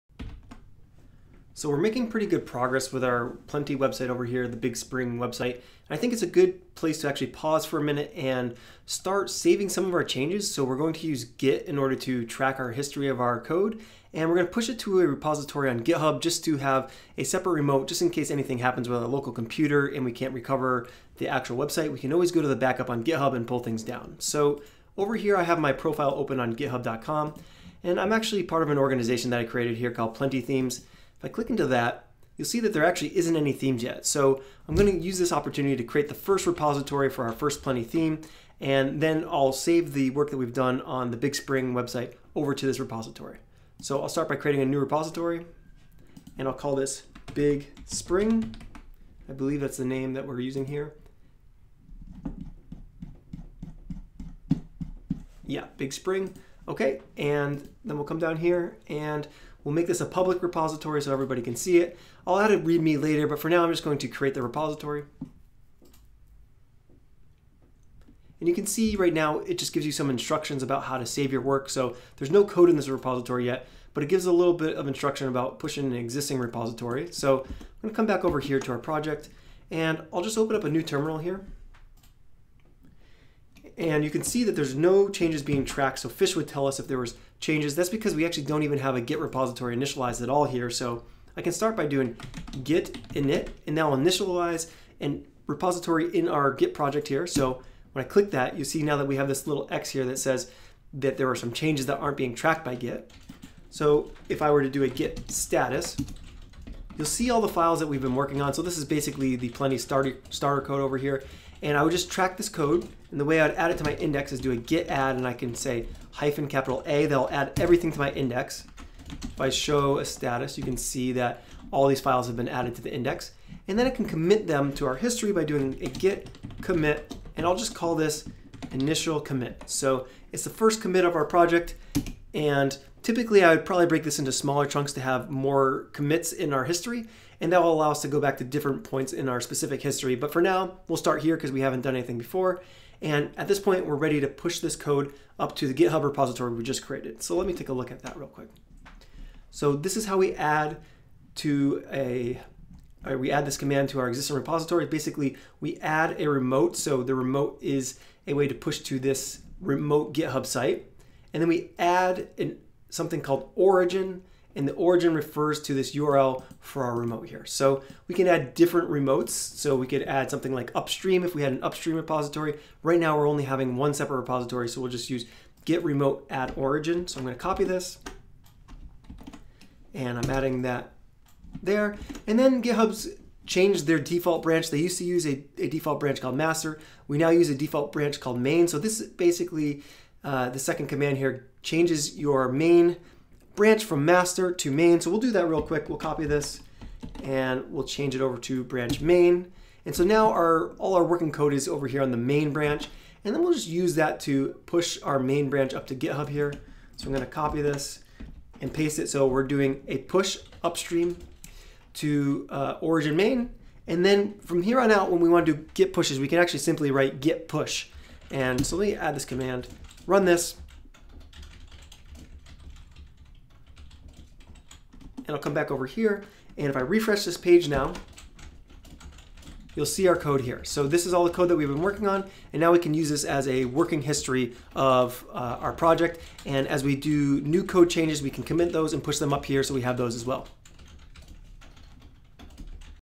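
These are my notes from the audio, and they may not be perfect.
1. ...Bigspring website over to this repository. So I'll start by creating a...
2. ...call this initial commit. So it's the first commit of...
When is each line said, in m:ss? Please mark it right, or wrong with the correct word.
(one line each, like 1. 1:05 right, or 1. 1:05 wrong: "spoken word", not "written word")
1. 0:41 right
2. 2:07 right.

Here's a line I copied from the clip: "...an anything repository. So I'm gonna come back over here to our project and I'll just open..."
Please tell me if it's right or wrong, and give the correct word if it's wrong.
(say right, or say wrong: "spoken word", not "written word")
wrong: "existing", not "anything".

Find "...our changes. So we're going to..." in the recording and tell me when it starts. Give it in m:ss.
0:09.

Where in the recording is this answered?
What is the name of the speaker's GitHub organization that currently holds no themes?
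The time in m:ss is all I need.
0:30.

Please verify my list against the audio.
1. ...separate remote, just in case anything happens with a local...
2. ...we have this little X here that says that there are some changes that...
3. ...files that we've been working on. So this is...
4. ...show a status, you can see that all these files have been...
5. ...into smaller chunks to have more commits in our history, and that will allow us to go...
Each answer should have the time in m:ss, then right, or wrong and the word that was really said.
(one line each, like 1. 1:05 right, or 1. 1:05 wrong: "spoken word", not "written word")
1. 0:17 right
2. 1:39 right
3. 1:47 right
4. 1:59 right
5. 2:14 right.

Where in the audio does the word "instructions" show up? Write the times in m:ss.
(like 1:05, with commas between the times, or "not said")
1:10, 1:14.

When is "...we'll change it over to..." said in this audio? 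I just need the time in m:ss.
3:17.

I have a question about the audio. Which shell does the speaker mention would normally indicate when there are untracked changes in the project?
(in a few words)
Fish.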